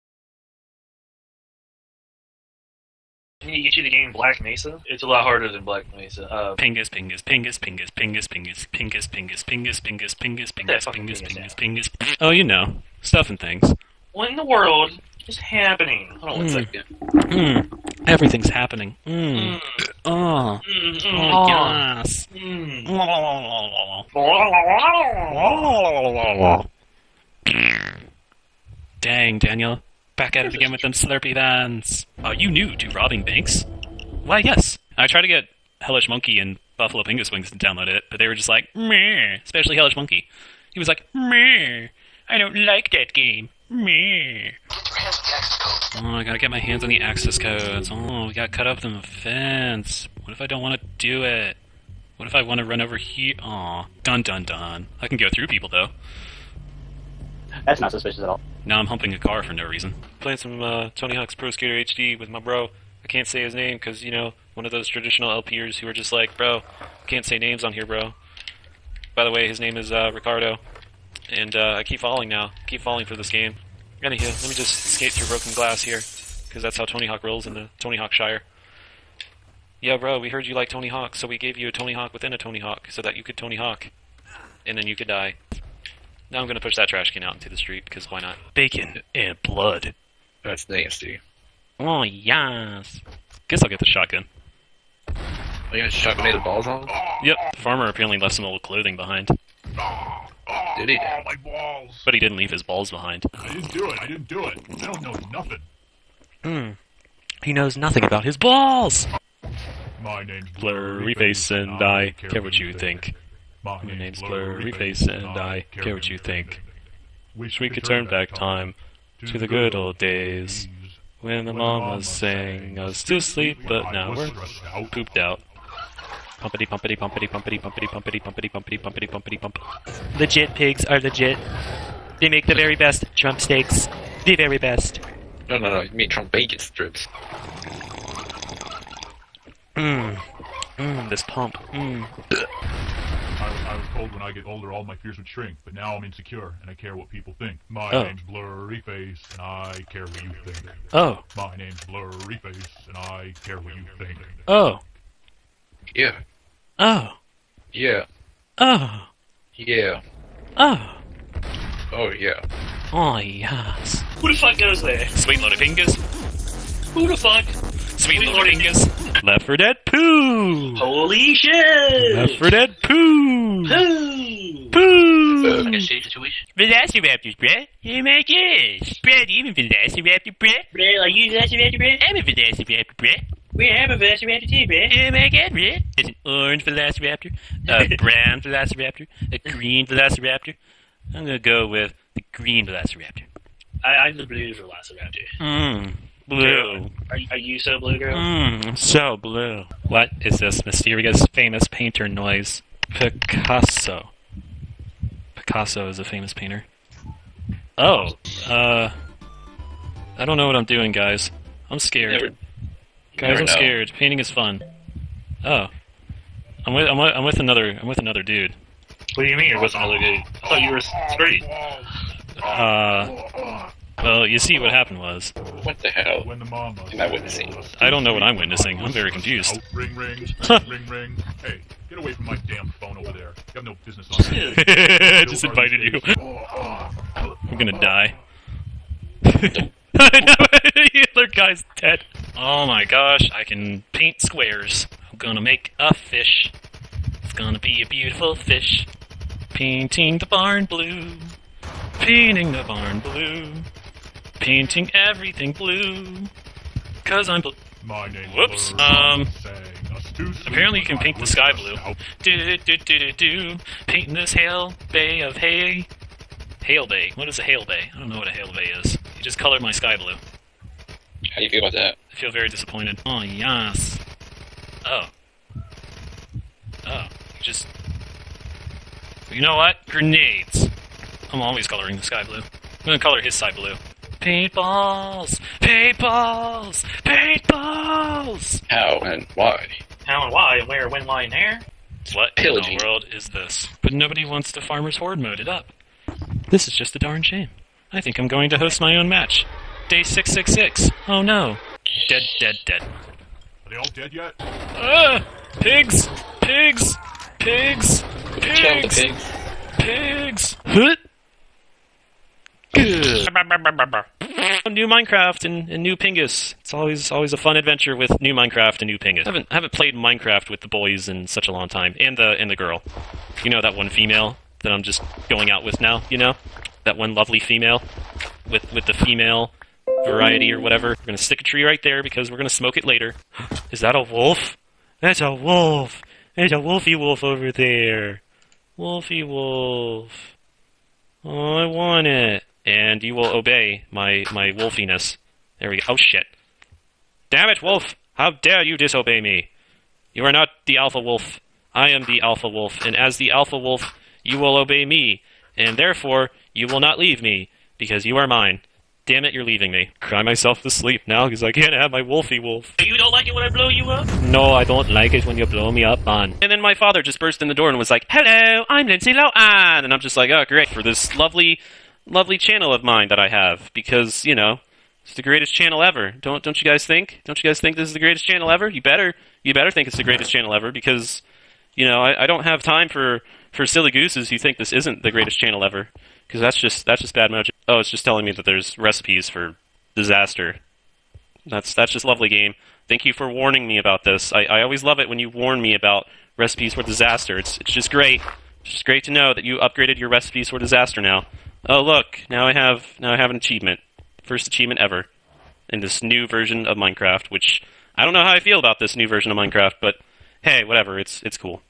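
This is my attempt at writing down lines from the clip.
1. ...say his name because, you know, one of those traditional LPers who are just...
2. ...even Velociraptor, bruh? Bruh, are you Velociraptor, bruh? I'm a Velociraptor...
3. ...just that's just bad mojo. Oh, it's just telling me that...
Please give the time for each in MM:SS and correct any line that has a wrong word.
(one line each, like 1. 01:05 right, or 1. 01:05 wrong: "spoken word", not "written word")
1. 01:03 right
2. 02:59 right
3. 06:26 right.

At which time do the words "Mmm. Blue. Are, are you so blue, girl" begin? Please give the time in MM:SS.
03:15.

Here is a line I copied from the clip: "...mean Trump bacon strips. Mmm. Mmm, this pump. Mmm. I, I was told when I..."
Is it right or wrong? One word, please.
right.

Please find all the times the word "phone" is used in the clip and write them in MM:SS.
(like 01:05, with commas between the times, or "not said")
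03:52.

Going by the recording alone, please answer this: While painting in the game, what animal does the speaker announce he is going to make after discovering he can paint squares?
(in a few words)
a fish.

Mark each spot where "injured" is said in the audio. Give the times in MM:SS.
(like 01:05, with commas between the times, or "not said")
not said.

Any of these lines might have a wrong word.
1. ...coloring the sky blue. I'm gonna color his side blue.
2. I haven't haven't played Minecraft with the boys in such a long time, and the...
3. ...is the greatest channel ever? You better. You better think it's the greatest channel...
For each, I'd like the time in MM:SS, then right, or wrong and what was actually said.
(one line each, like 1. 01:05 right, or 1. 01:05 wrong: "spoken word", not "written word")
1. 04:41 right
2. 05:19 right
3. 06:17 right.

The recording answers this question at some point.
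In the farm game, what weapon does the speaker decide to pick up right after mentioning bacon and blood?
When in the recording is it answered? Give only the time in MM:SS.
01:33.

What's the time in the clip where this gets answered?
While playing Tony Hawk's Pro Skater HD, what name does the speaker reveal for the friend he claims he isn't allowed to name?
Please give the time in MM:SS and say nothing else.
01:10.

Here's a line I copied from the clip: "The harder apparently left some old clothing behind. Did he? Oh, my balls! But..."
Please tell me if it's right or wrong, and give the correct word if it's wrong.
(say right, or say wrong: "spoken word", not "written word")
wrong: "farmer", not "harder".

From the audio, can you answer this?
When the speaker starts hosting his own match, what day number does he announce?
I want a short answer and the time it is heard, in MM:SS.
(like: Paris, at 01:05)
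Day 666, at 04:59.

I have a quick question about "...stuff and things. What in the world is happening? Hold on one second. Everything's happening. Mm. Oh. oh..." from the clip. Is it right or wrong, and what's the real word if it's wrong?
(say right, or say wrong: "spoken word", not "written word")
right.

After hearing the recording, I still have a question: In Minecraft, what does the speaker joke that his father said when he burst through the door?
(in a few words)
Hello, I'm Lindsay Lohan.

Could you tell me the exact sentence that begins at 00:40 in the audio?
He was like, meh, I don't like that game, meh.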